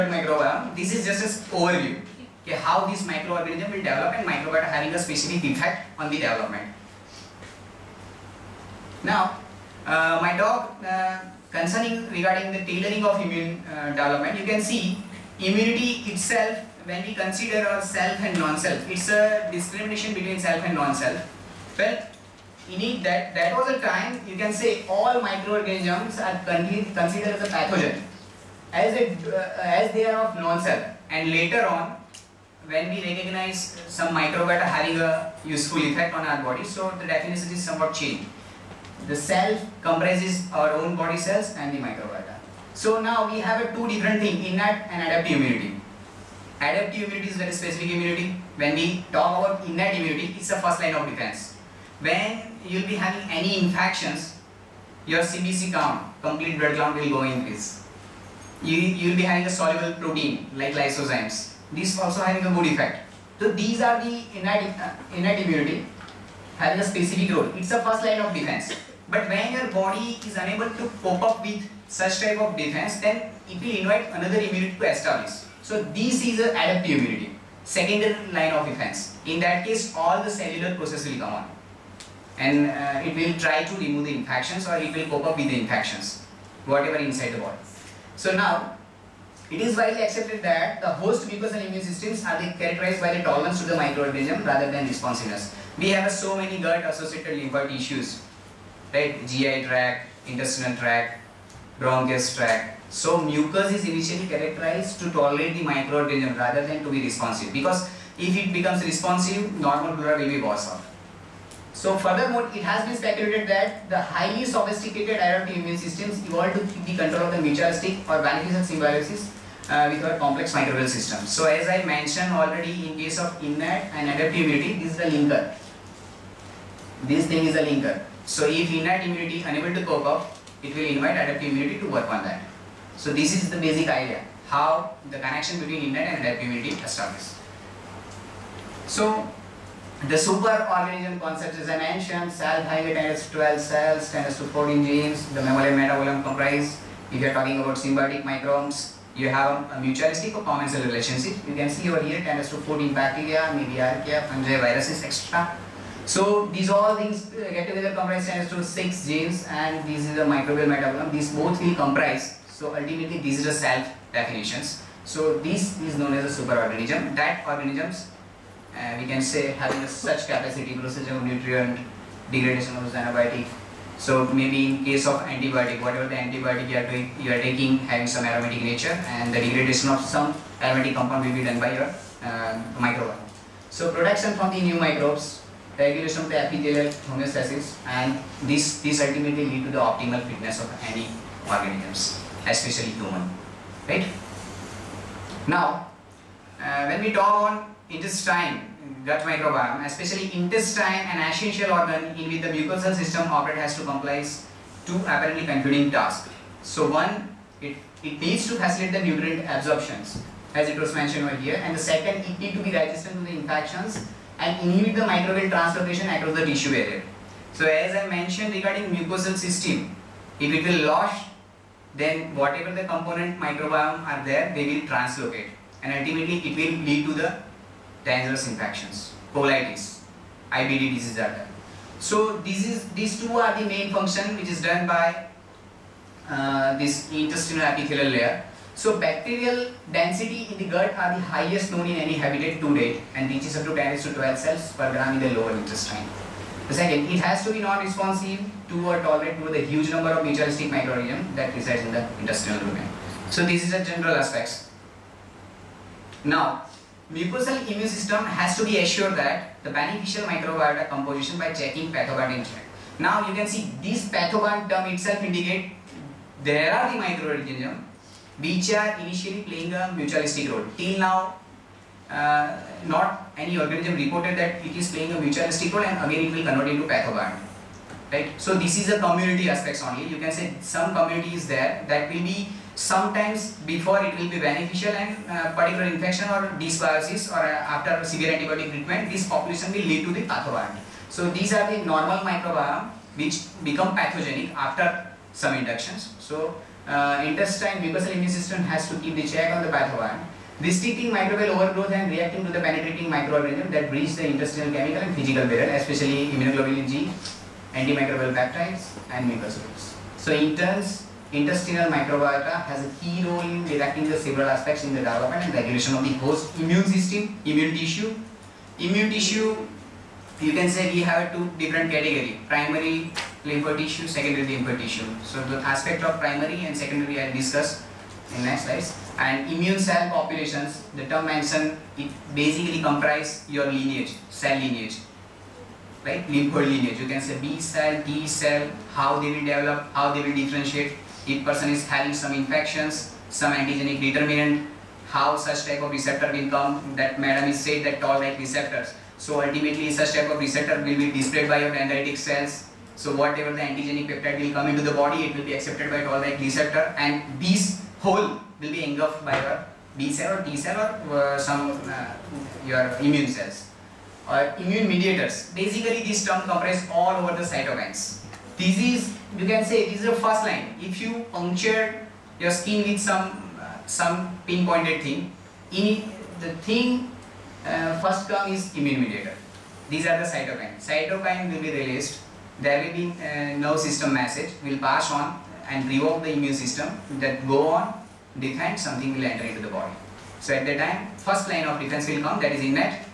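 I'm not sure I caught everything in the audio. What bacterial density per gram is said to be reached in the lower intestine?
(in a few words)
10 to 12 cells.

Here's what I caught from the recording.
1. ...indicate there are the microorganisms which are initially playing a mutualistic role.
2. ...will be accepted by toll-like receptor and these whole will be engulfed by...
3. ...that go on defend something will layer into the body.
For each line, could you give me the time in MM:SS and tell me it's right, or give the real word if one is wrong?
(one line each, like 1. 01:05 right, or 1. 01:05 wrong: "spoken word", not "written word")
1. 04:25 right
2. 05:55 right
3. 06:27 wrong: "enter", not "layer".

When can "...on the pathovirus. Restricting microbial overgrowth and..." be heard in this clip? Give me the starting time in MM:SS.
04:59.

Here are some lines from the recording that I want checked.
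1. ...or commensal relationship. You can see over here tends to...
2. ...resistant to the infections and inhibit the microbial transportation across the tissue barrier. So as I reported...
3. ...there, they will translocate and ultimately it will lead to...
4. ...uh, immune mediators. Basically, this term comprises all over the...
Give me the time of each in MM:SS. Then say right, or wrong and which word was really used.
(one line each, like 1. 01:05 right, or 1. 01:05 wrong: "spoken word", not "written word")
1. 02:30 right
2. 03:32 wrong: "mentioned", not "reported"
3. 03:44 right
4. 06:04 right.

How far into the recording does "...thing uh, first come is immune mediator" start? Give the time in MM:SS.
06:16.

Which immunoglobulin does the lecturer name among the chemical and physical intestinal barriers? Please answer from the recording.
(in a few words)
immunoglobulin G.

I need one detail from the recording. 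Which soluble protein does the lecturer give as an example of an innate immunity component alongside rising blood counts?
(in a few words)
lysozymes.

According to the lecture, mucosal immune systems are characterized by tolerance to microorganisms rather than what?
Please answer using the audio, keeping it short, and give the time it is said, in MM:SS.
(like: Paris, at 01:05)
responsiveness, at 01:34.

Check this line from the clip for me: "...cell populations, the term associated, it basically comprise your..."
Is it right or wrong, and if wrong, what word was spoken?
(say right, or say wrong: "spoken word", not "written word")
wrong: "mentioned", not "associated".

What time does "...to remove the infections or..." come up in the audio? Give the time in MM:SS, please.
01:23.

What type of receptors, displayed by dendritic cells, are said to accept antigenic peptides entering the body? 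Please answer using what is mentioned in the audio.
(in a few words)
toll-like receptors.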